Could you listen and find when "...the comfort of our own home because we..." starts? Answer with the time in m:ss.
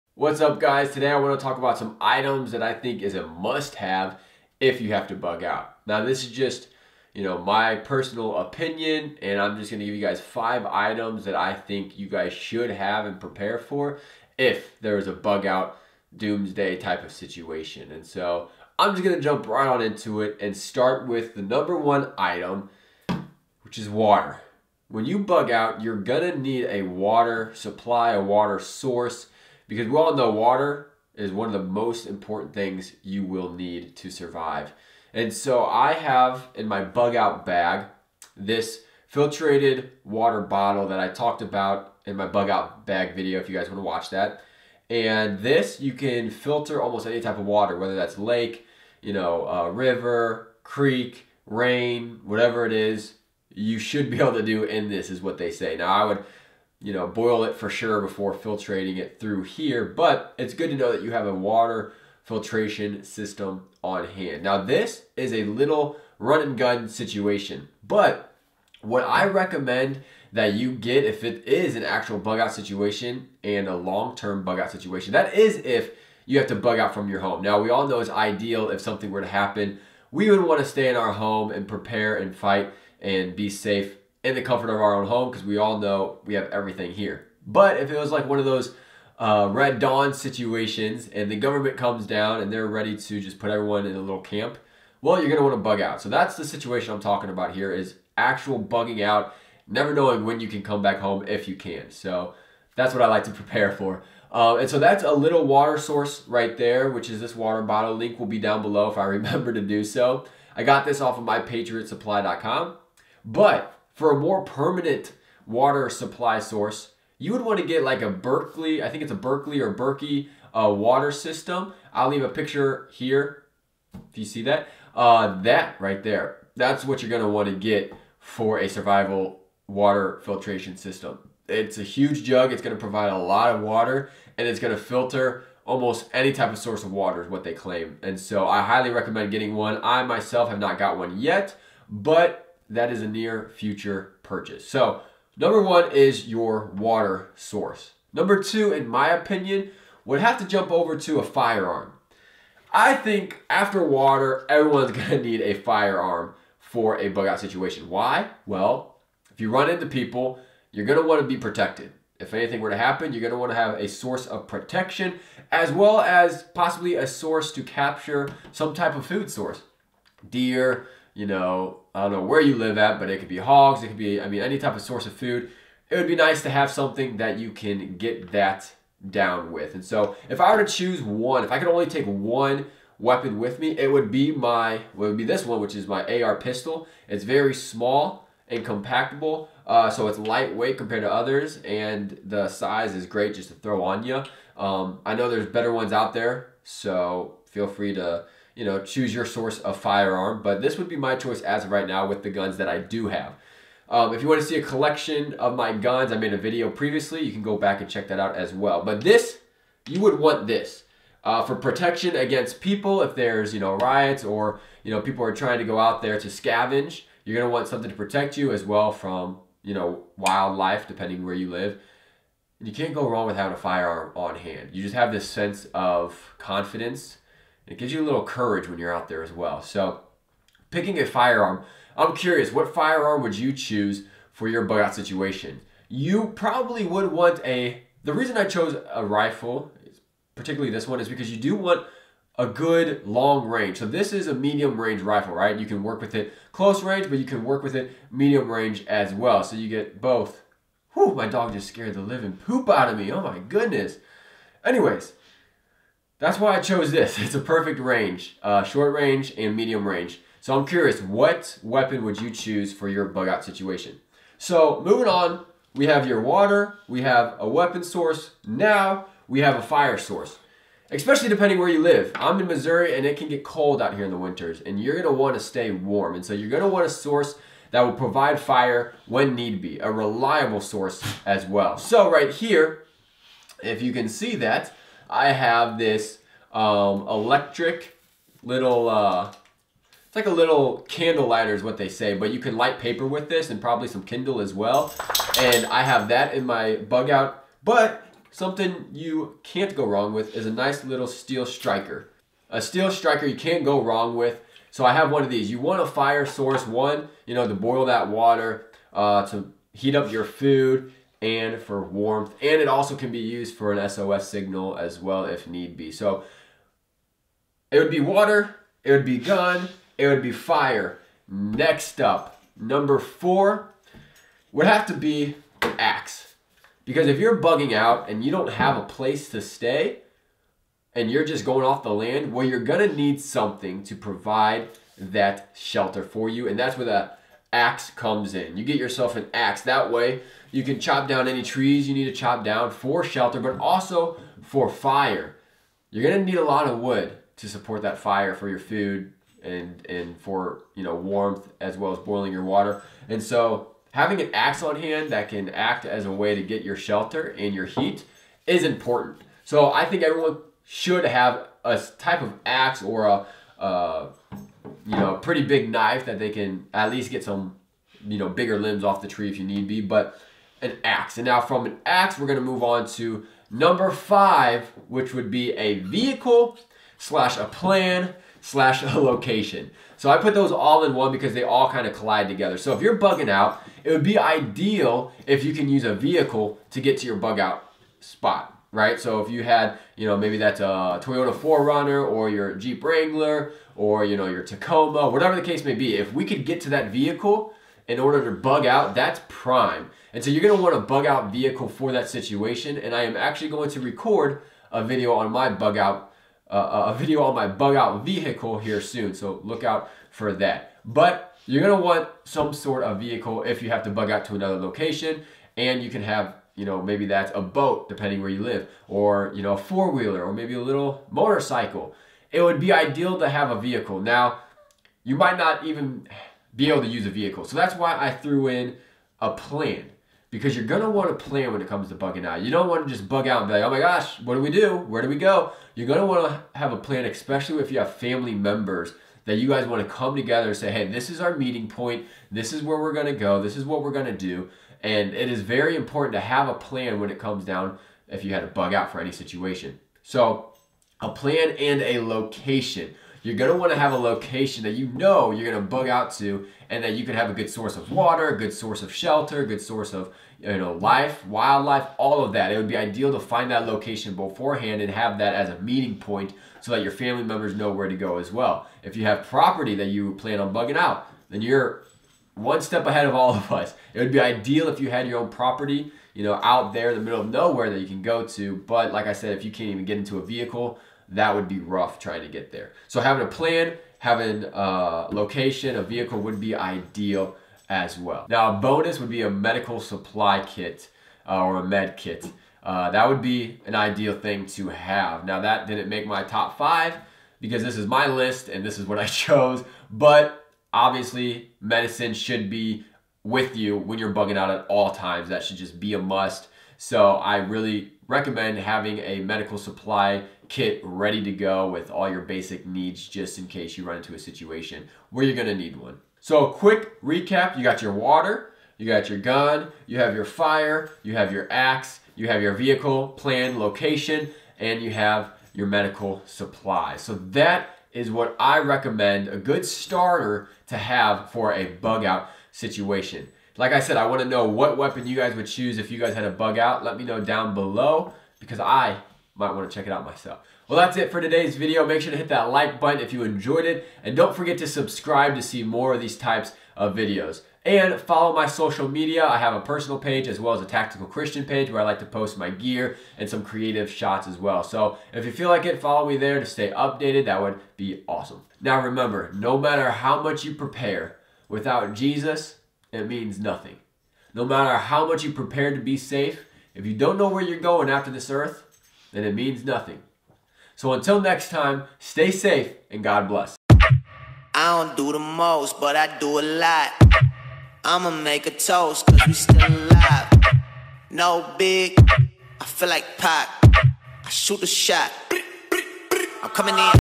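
1:24.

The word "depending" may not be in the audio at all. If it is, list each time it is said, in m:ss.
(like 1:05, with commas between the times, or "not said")
3:40, 4:31, 6:57.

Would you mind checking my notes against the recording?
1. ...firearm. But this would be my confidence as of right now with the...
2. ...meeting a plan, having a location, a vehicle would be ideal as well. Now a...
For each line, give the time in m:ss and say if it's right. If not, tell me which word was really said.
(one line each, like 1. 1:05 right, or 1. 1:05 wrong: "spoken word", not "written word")
1. 3:19 wrong: "choice", not "confidence"
2. 8:03 wrong: "having", not "meeting".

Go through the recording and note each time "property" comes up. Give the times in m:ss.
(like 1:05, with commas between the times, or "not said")
7:49, 7:55.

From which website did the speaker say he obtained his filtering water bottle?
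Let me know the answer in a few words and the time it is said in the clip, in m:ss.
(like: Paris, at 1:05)
mypatriotsupply.com, at 1:51.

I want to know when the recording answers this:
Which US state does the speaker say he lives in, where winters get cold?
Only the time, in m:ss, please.
4:32.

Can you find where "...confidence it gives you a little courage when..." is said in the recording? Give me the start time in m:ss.
3:46.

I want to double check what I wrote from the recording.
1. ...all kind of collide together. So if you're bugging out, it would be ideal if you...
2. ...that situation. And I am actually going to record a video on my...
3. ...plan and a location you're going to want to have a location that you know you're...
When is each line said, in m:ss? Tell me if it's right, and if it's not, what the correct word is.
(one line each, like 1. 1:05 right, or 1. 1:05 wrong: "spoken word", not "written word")
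1. 6:21 right
2. 6:41 right
3. 7:31 right.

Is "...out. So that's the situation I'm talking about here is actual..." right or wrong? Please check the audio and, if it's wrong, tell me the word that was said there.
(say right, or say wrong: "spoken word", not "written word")
right.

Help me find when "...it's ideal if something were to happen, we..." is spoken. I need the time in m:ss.
1:17.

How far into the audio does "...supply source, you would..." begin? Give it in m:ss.
1:55.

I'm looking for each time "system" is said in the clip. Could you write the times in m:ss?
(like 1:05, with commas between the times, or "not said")
1:03, 2:01, 2:10.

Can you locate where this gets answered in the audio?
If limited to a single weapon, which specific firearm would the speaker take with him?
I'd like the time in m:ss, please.
3:06.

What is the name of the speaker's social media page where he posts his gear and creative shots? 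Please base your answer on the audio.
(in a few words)
Tactical Christian.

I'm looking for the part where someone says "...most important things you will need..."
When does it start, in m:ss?
0:31.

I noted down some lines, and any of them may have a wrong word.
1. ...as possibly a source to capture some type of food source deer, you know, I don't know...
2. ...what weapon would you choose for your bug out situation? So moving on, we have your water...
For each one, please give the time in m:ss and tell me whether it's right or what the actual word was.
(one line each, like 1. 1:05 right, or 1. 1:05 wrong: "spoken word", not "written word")
1. 2:45 right
2. 4:21 right.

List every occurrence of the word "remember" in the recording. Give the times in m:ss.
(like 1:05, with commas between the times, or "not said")
1:49, 9:18.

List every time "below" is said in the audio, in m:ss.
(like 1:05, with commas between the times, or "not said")
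1:48, 8:57.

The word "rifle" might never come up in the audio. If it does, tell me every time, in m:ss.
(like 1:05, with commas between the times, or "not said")
3:59, 4:05.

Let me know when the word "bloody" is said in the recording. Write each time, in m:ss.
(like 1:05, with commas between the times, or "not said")
not said.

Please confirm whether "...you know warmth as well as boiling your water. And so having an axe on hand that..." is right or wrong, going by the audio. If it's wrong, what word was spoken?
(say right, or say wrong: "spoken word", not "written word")
right.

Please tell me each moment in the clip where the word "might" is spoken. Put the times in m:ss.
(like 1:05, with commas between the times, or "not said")
7:05, 8:59.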